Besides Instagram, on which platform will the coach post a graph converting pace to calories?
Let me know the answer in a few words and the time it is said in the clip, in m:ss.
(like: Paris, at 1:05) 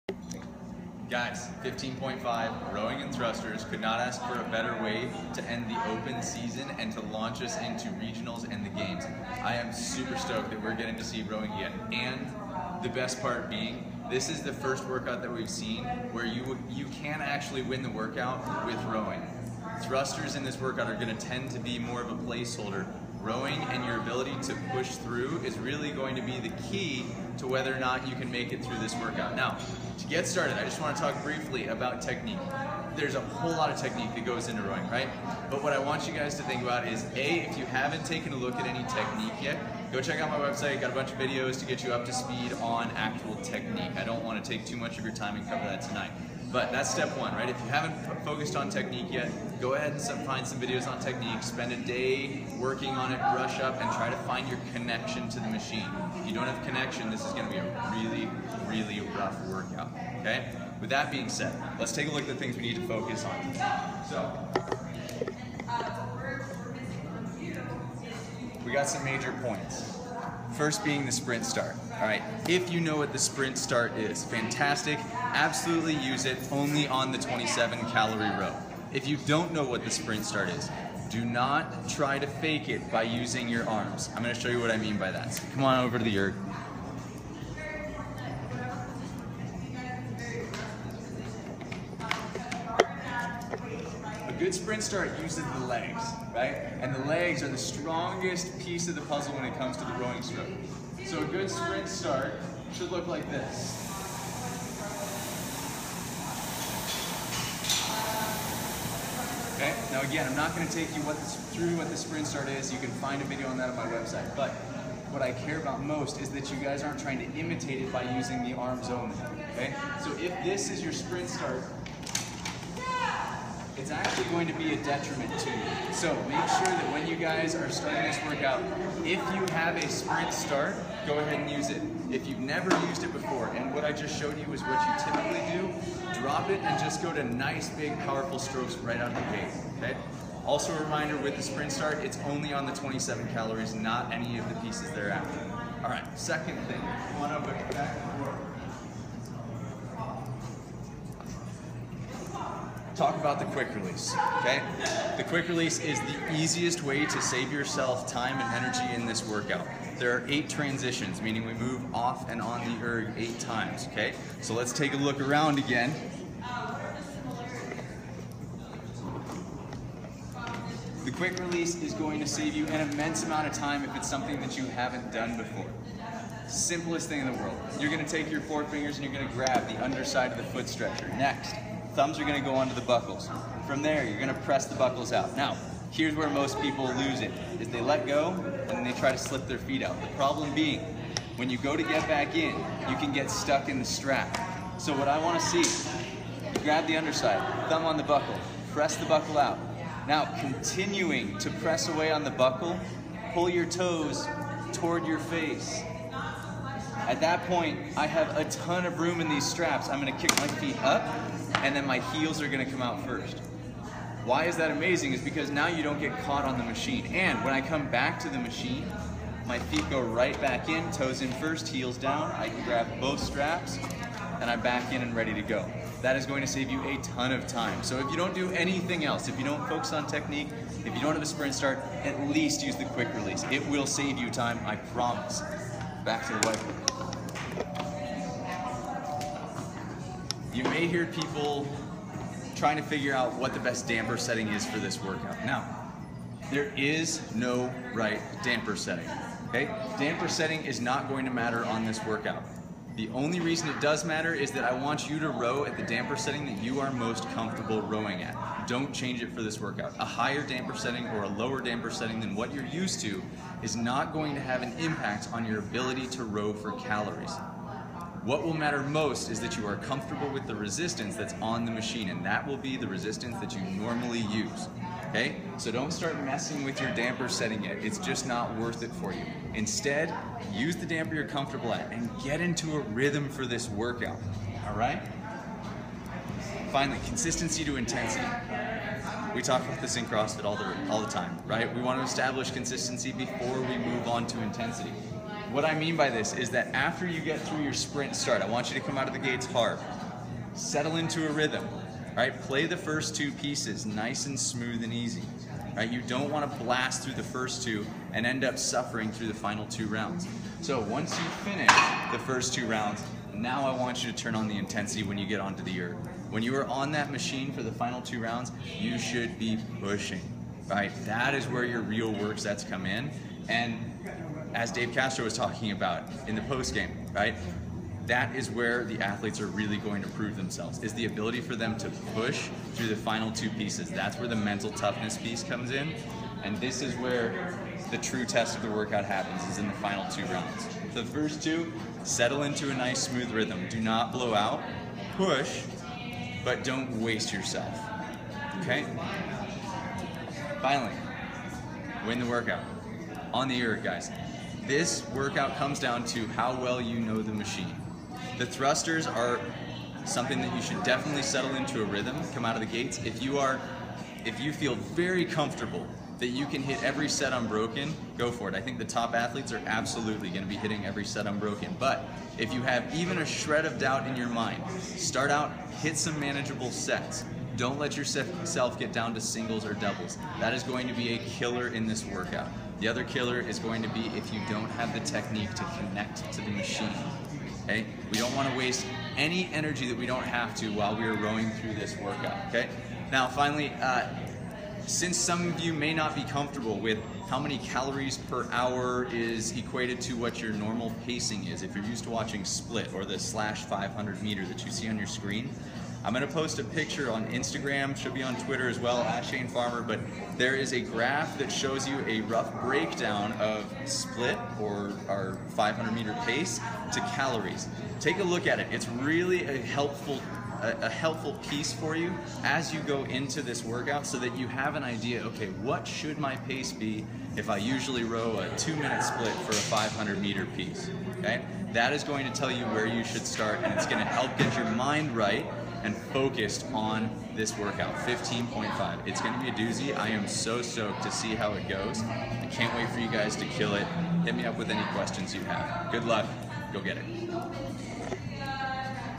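Twitter, at 6:48.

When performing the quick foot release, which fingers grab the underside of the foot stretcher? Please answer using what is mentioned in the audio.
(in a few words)
Forefingers.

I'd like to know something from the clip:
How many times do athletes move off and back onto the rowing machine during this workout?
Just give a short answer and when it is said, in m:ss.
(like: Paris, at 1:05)
8, at 2:40.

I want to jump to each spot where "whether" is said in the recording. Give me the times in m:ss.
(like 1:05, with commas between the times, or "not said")
0:27.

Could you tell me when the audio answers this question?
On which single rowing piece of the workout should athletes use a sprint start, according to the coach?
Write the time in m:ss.
1:17.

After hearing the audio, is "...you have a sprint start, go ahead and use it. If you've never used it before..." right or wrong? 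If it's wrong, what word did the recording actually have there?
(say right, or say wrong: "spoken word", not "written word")
right.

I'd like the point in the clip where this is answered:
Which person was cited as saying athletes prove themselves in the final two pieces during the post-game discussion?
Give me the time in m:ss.
5:24.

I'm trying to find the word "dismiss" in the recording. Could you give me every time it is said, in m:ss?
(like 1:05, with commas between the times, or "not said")
not said.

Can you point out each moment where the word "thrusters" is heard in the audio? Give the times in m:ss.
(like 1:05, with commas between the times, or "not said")
0:03, 0:19, 5:58.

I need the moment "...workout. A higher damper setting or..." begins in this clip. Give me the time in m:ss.
4:19.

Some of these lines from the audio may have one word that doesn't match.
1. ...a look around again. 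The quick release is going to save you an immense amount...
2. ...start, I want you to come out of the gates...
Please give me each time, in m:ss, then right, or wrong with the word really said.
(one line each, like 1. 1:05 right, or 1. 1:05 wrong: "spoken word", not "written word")
1. 2:44 right
2. 4:58 right.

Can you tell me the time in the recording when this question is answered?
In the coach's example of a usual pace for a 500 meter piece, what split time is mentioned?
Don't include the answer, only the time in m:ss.
7:08.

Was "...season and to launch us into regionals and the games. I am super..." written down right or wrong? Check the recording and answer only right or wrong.
right.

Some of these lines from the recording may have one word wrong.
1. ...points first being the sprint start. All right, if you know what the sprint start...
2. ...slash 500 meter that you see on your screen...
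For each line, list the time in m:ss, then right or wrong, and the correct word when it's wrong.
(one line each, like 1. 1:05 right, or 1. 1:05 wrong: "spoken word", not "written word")
1. 1:09 right
2. 6:43 right.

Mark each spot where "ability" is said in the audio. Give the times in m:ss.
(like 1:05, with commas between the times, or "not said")
0:23, 4:25, 5:31.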